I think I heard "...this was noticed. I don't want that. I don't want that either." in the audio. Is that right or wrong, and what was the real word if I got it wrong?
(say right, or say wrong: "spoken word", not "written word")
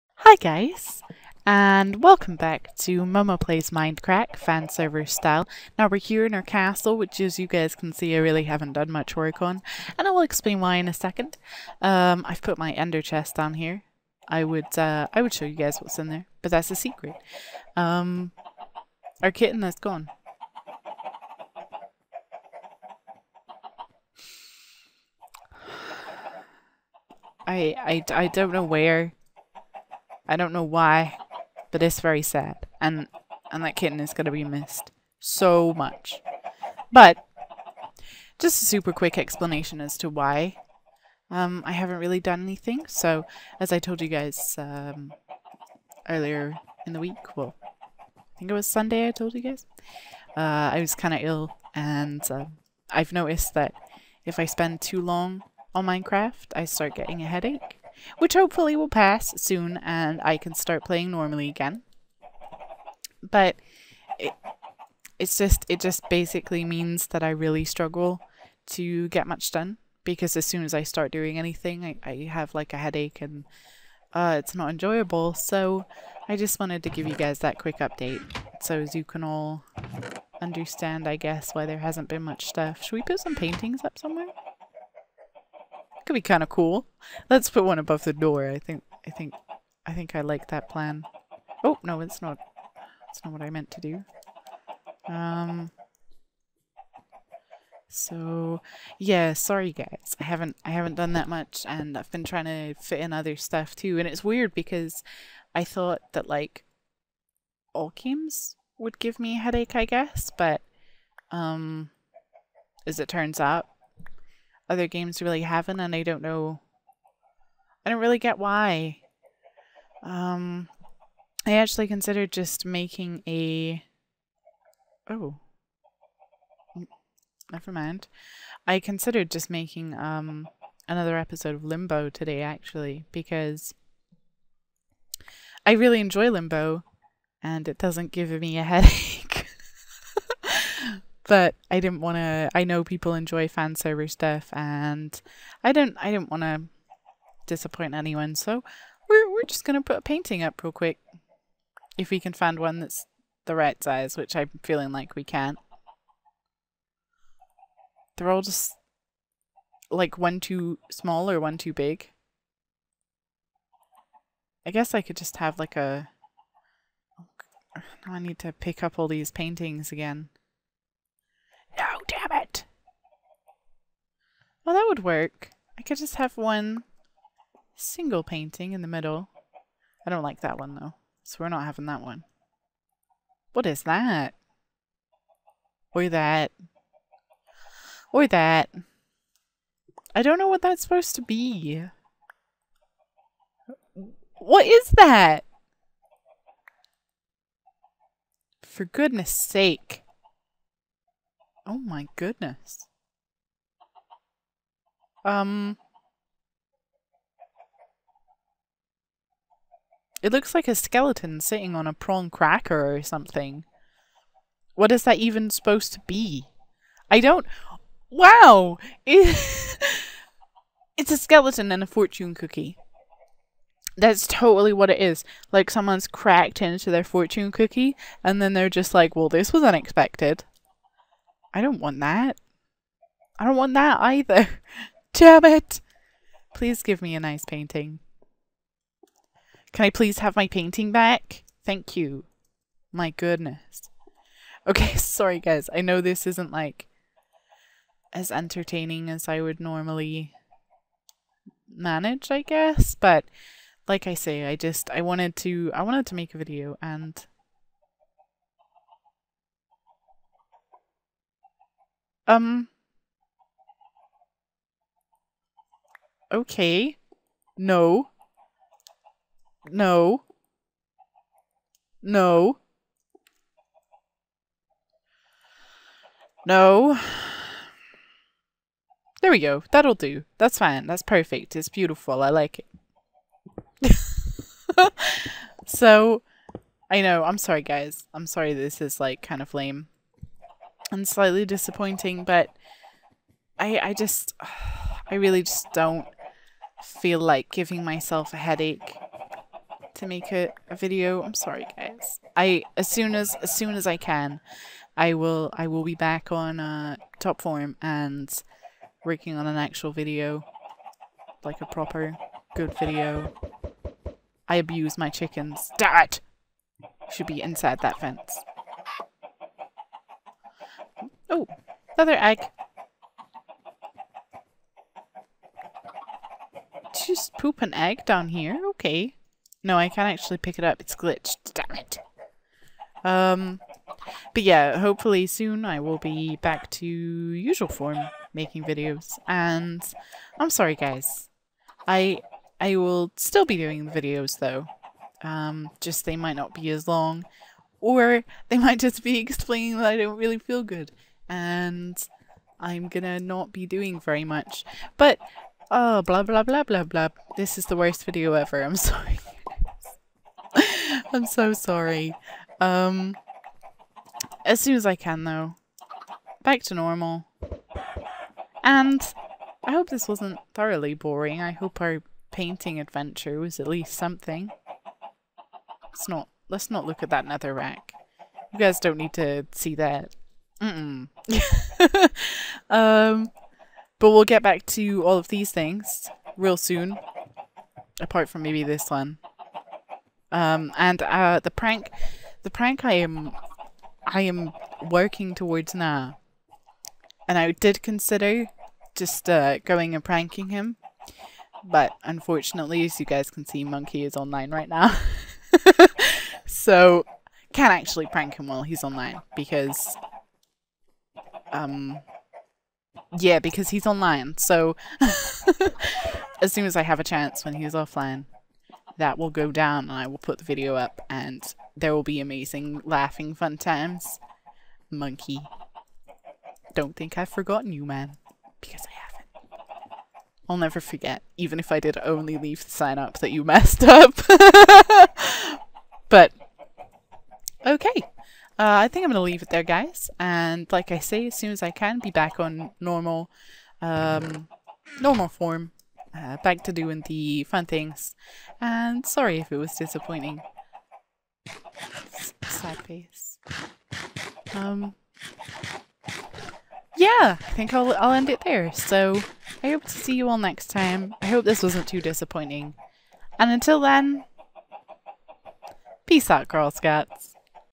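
wrong: "unexpected", not "noticed".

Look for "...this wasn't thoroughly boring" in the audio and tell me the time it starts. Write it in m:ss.
6:09.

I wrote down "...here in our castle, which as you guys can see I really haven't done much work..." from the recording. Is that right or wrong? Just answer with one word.
right.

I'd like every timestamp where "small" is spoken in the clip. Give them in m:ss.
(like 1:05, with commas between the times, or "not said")
2:40.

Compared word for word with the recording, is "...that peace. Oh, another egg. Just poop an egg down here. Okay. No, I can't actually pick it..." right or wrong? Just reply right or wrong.
wrong.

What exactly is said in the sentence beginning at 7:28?
And sorry if it was disappointing.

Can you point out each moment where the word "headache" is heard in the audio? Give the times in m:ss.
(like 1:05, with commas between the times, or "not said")
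0:57, 1:12, 1:49, 2:18, 4:58.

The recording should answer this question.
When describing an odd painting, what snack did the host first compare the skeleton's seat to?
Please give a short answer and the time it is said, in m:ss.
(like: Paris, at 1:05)
Prawn cracker, at 3:31.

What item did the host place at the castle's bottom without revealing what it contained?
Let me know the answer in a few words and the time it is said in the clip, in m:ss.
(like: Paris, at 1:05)
Ender chest, at 0:12.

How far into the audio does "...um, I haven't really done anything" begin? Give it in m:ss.
0:41.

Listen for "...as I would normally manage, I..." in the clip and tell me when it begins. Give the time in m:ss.
4:09.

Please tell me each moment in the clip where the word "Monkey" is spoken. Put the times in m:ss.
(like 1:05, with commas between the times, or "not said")
6:43, 7:04.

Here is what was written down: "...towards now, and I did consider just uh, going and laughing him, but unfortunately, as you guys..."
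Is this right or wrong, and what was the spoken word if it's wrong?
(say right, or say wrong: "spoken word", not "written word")
wrong: "pranking", not "laughing".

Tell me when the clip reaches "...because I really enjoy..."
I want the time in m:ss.
2:13.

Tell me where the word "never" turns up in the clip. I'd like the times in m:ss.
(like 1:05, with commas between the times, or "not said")
2:07, 7:10.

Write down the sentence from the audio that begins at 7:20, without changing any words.
And like I say, as soon as I can, be back on normal, um, normal form.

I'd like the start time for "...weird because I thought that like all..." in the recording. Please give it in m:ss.
1:44.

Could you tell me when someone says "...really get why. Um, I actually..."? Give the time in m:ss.
1:57.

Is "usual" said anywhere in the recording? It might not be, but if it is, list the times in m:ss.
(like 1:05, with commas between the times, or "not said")
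5:36.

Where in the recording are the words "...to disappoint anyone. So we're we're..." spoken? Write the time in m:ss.
2:26.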